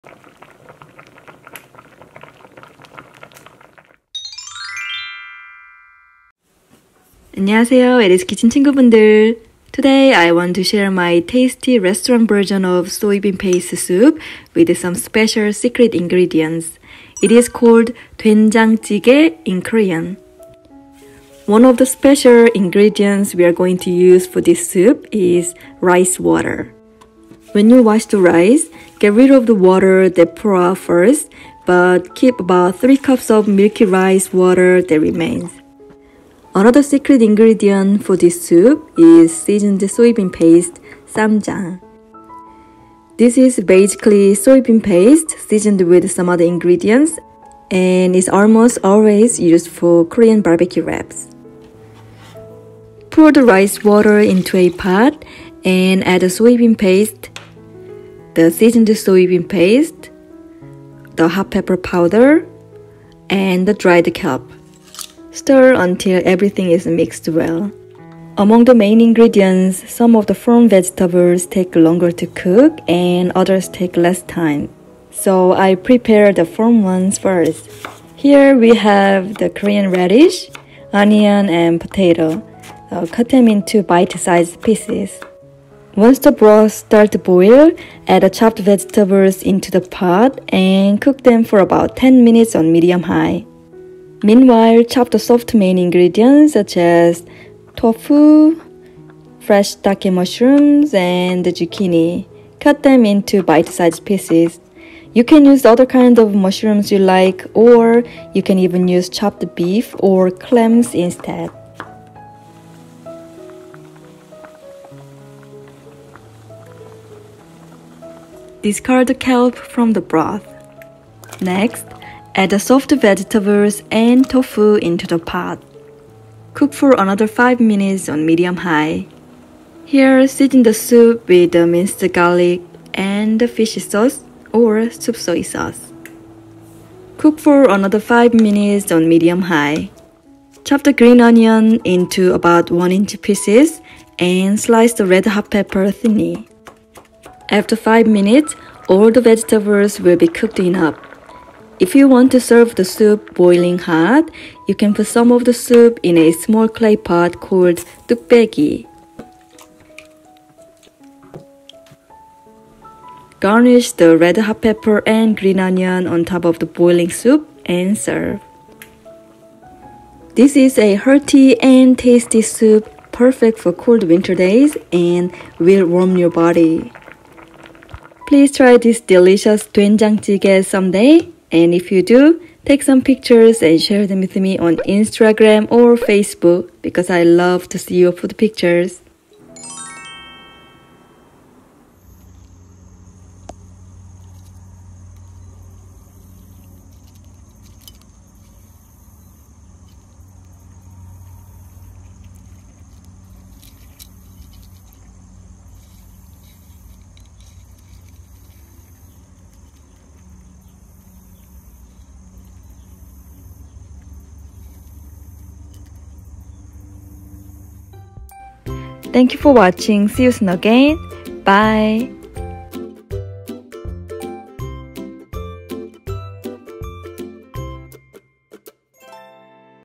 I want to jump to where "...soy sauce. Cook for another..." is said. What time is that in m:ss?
2:15.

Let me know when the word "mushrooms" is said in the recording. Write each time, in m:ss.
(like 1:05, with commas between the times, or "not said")
1:40, 1:46.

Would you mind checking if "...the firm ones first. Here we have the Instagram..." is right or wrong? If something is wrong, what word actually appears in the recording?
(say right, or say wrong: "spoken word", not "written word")
wrong: "Korean", not "Instagram".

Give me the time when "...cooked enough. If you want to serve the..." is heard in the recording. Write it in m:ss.
2:30.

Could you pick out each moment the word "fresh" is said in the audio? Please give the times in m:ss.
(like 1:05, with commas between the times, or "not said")
1:39.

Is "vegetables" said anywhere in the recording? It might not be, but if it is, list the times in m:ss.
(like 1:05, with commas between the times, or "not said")
1:10, 1:28, 2:02, 2:29.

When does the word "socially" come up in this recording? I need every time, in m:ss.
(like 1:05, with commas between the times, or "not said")
not said.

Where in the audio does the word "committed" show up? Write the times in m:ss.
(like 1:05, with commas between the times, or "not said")
not said.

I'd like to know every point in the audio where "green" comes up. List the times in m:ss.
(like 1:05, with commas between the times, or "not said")
2:20, 2:45.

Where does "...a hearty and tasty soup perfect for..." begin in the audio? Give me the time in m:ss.
2:50.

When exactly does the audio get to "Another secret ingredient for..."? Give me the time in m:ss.
0:36.